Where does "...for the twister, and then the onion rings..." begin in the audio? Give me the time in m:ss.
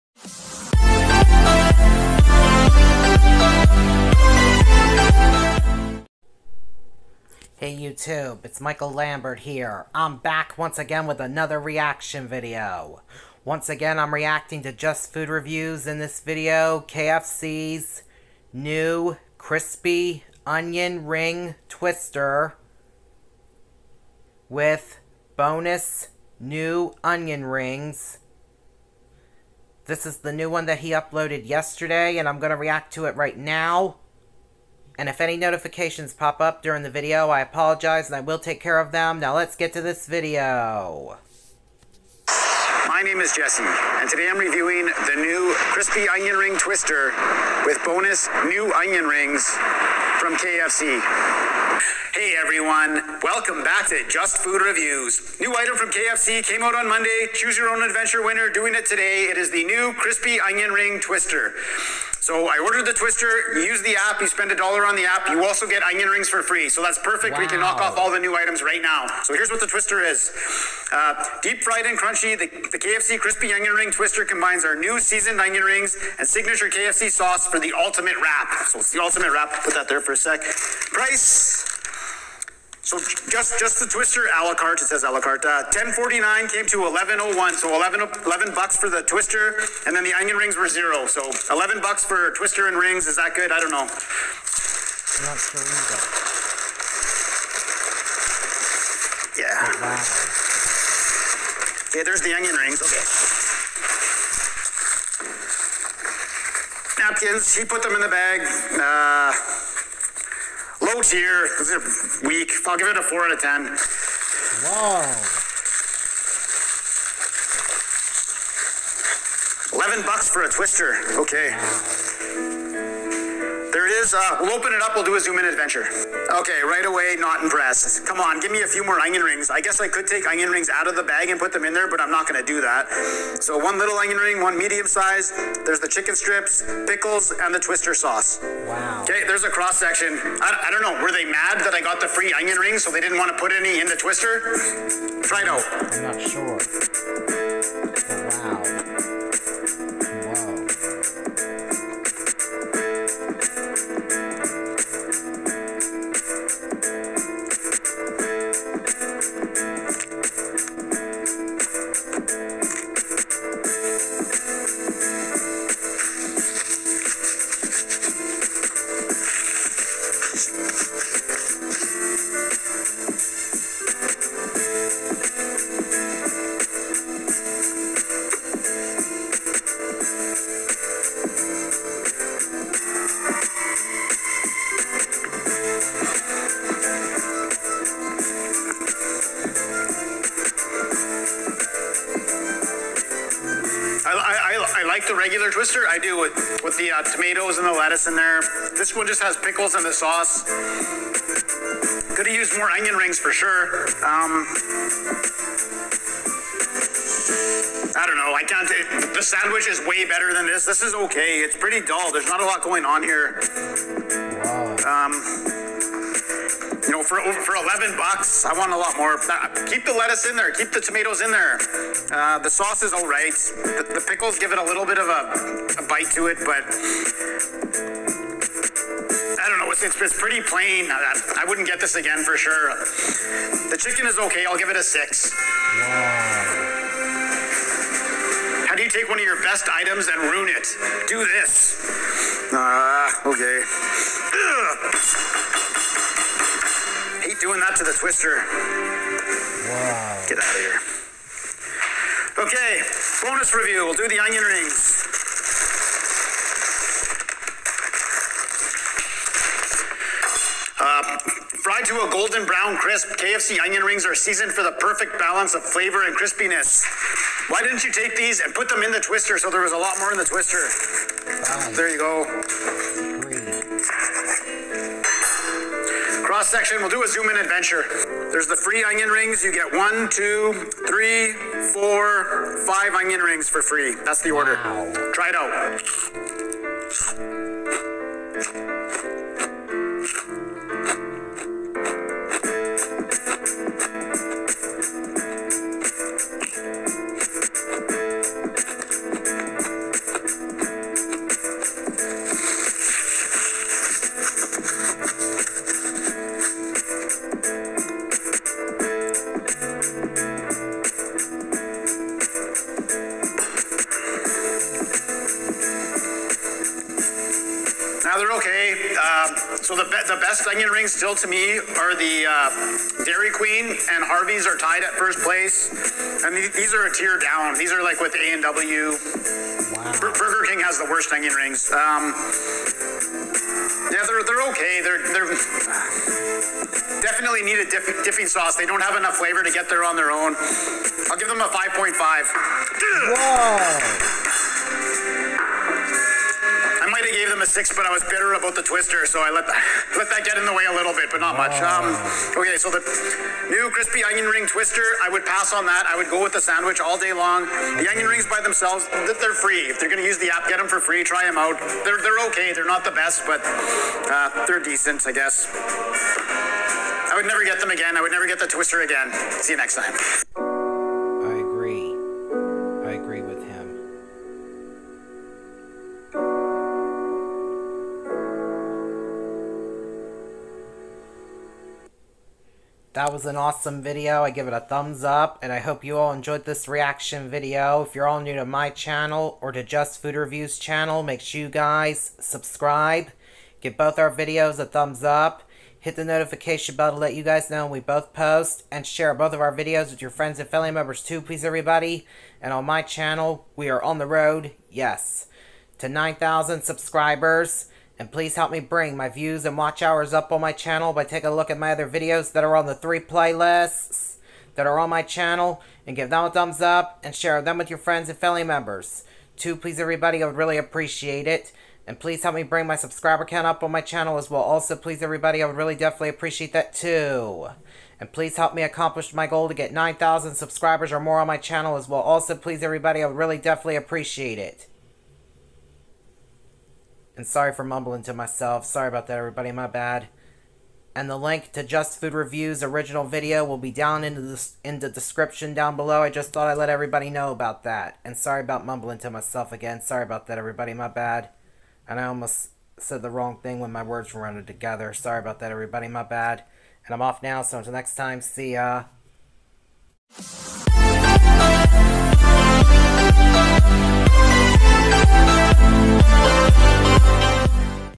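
1:28.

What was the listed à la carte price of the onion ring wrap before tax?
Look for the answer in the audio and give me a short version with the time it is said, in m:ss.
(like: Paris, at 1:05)
$10.49, at 1:25.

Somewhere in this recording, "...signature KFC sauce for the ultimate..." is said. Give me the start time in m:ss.
1:16.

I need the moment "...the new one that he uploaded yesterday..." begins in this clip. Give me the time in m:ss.
0:30.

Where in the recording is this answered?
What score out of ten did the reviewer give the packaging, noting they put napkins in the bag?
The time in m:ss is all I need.
1:53.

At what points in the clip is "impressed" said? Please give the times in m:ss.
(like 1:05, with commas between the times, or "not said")
2:07.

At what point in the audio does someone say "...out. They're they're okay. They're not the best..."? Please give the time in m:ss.
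6:01.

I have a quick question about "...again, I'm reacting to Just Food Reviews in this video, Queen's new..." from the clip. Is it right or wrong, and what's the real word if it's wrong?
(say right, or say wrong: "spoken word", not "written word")
wrong: "KFC", not "Queen".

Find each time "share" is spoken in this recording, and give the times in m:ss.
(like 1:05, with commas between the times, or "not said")
6:38, 6:57.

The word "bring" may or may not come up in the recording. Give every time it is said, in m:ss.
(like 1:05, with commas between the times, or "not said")
6:48, 7:02.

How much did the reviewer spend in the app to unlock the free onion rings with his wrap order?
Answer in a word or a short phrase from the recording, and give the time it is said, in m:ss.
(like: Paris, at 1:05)
a dollar, at 1:04.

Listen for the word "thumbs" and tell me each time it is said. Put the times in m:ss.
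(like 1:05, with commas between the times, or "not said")
6:24, 6:34, 6:56.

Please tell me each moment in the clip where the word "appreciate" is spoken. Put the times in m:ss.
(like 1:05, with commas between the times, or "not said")
7:00, 7:06, 7:13.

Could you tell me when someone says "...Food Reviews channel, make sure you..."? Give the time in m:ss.
6:30.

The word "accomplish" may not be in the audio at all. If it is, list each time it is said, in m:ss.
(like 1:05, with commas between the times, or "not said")
7:08.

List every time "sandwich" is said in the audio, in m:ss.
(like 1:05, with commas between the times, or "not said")
3:29, 5:56.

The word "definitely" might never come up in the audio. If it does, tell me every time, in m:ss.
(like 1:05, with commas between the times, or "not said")
5:37, 7:05, 7:13.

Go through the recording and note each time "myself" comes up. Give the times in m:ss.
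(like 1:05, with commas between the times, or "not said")
7:18, 7:29.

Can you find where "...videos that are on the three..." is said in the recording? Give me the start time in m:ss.
6:51.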